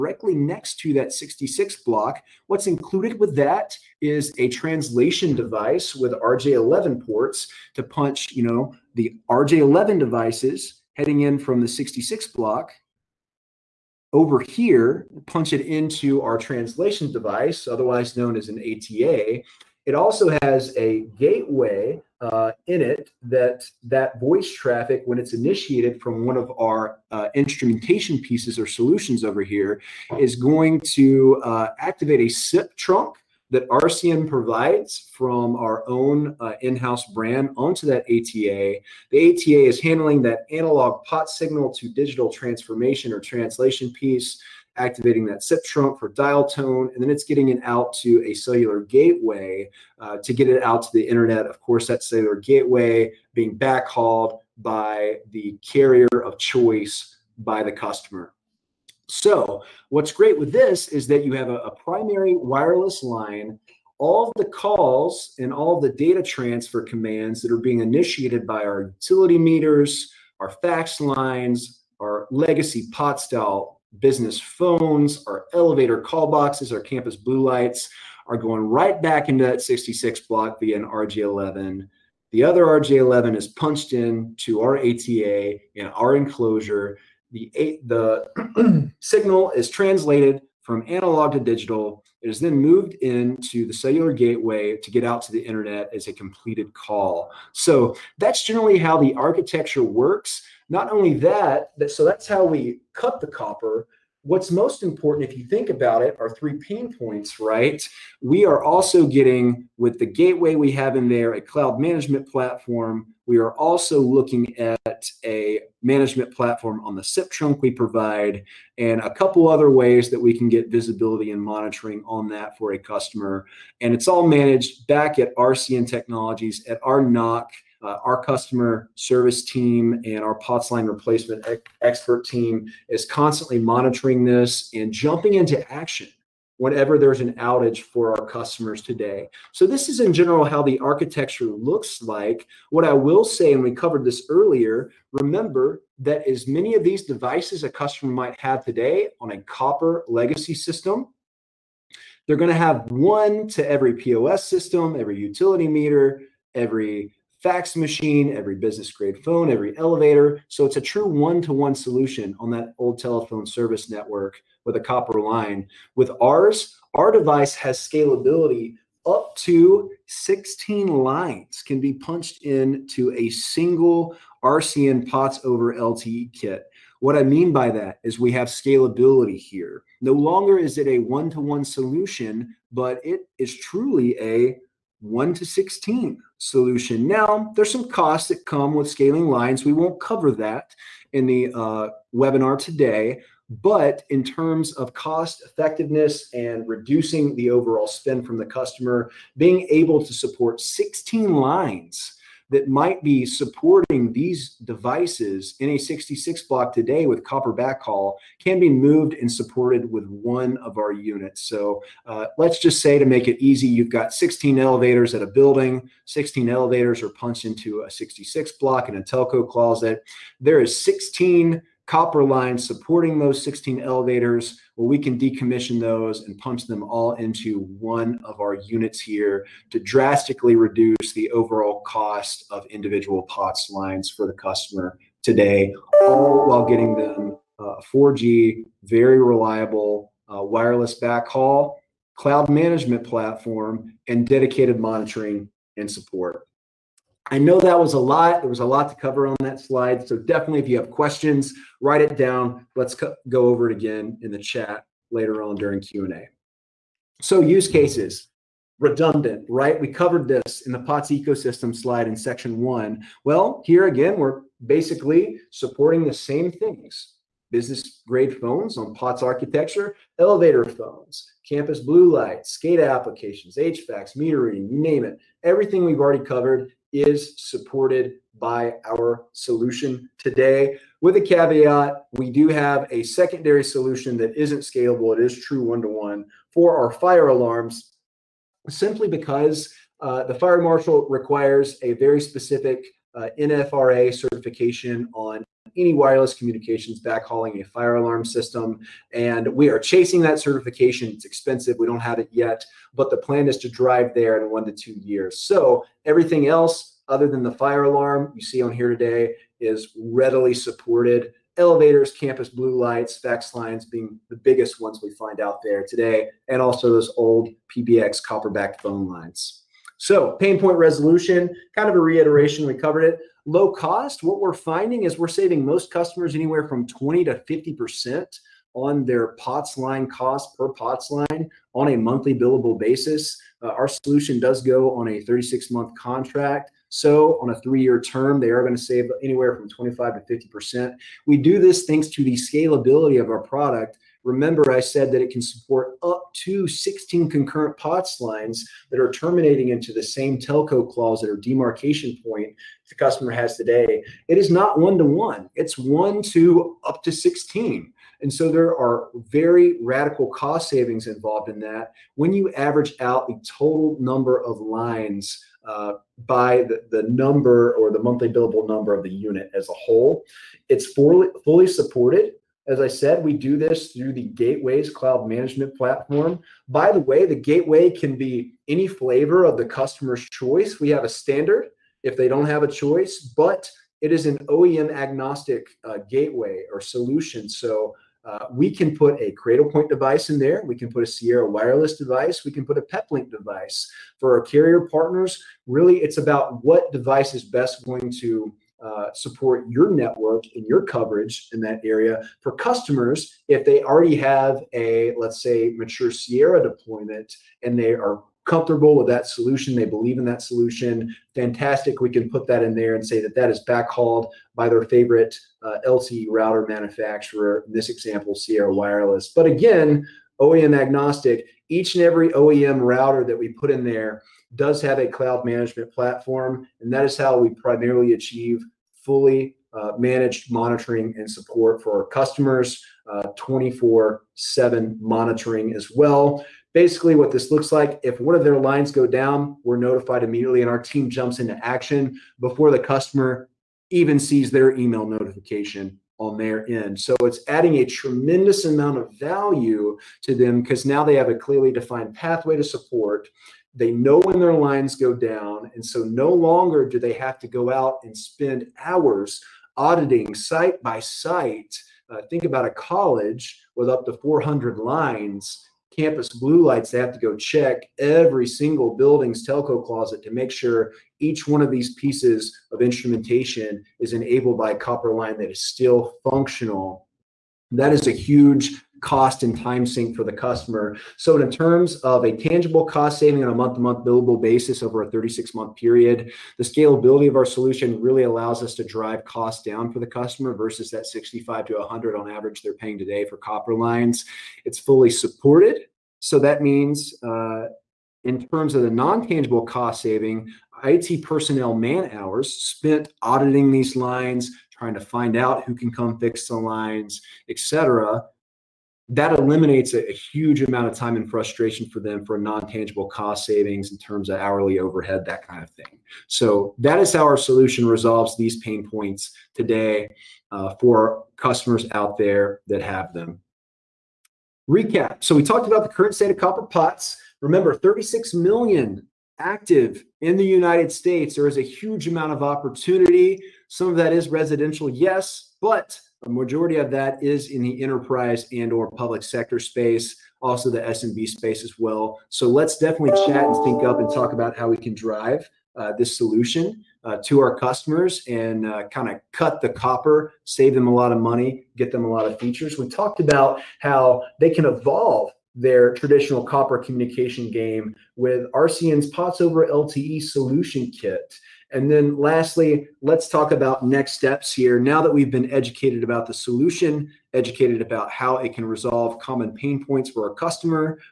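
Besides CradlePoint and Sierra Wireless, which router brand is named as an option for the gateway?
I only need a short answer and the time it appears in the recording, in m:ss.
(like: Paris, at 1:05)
PepLink, at 6:32.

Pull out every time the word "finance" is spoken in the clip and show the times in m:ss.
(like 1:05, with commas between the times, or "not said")
not said.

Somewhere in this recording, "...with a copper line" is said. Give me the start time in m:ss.
2:44.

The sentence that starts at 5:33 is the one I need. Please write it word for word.
Uh, our solution does go on a 36 month contract.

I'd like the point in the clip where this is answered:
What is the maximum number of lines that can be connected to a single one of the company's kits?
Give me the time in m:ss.
2:49.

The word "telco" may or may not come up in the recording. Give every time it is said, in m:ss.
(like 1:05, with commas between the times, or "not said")
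3:39, 5:50, 7:49.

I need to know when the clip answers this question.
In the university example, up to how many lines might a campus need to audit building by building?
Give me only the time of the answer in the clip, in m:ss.
7:44.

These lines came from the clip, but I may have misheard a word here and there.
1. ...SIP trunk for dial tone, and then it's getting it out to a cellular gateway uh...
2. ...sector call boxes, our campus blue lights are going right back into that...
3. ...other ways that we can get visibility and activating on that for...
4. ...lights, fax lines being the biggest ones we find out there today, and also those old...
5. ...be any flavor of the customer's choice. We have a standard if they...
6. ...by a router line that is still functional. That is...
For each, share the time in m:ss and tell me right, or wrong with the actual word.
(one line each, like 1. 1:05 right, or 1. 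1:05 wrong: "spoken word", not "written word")
1. 0:45 right
2. 1:15 wrong: "elevator", not "sector"
3. 1:59 wrong: "monitoring", not "activating"
4. 5:12 right
5. 6:18 right
6. 7:54 wrong: "copper", not "router".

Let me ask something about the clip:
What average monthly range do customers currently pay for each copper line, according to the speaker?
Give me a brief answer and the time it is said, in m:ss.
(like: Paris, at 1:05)
65 to 100, at 8:11.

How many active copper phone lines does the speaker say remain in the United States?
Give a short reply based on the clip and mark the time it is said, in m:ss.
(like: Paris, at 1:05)
36 million, at 8:47.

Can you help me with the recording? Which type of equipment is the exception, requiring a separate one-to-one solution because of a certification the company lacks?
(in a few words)
fire alarms.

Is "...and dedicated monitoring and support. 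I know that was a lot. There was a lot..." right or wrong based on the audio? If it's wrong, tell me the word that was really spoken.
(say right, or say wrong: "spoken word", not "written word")
right.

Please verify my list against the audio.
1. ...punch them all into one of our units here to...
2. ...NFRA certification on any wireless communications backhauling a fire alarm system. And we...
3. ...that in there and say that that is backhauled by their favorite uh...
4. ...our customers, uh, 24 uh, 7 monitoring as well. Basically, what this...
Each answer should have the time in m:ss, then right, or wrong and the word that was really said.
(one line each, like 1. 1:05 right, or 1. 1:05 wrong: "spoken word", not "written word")
1. 3:46 right
2. 4:53 right
3. 6:52 right
4. 7:12 right.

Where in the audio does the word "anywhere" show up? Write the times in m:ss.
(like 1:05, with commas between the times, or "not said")
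5:26, 5:39.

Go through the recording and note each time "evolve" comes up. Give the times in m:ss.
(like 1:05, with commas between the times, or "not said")
9:14.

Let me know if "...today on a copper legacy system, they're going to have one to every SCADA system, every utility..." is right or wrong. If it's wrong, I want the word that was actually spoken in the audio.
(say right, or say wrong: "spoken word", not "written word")
wrong: "POS", not "SCADA".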